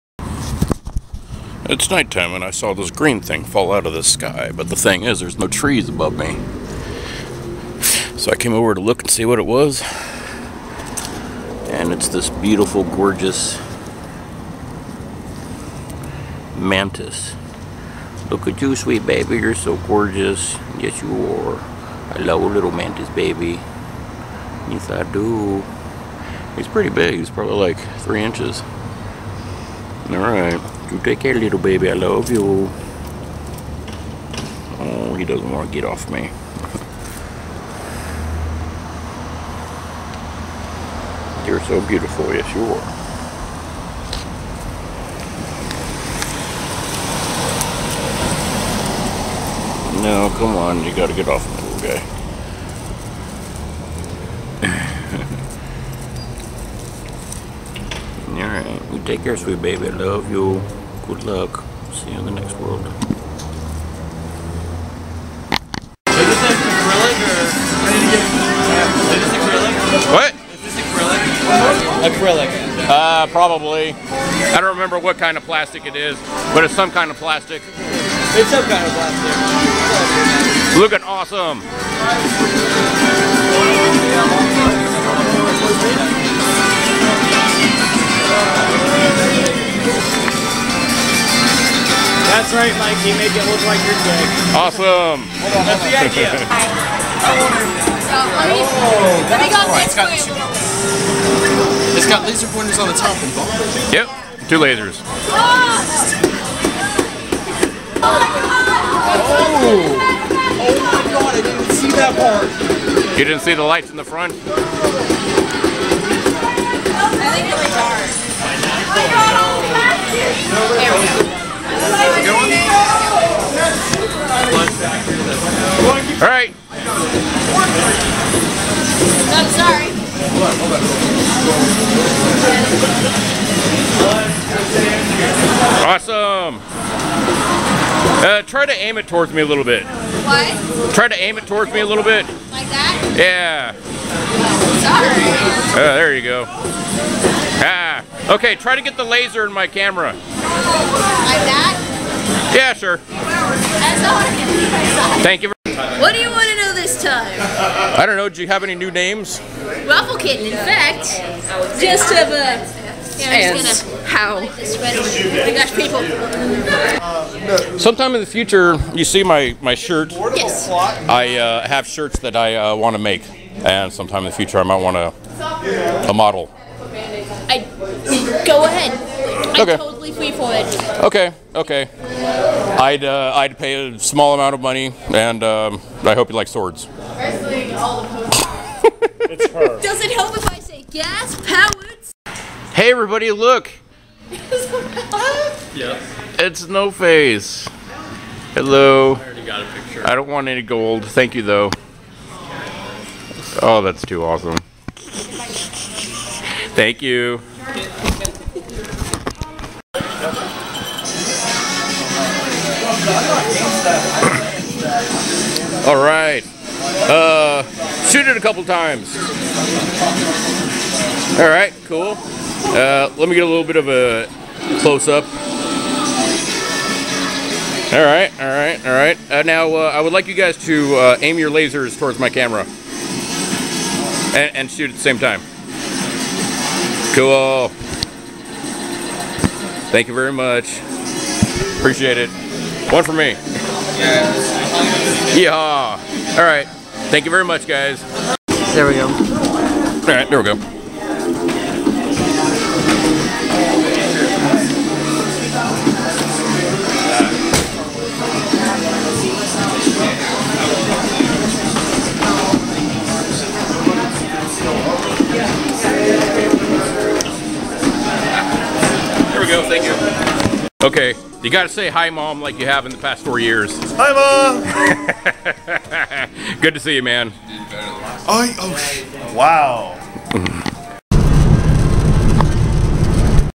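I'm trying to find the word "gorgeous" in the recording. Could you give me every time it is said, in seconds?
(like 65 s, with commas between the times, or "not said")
12 s, 19 s.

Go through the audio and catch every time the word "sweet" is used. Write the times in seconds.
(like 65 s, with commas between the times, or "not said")
18 s, 59 s.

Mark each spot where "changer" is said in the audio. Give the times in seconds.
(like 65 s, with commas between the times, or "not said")
not said.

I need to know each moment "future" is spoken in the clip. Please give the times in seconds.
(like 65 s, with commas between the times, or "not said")
168 s, 174 s.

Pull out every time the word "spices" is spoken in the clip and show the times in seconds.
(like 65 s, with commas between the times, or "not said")
not said.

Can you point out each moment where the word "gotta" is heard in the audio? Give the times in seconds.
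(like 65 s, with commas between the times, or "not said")
50 s, 271 s.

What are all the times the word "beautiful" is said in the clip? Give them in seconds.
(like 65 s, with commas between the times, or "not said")
12 s, 41 s.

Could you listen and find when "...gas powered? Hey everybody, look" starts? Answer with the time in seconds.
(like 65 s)
190 s.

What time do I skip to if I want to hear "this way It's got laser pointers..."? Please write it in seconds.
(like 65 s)
99 s.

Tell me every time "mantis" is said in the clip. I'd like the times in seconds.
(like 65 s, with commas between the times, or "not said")
16 s, 22 s.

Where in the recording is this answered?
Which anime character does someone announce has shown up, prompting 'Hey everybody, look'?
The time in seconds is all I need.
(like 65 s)
196 s.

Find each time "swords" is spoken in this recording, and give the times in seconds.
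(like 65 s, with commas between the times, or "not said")
186 s.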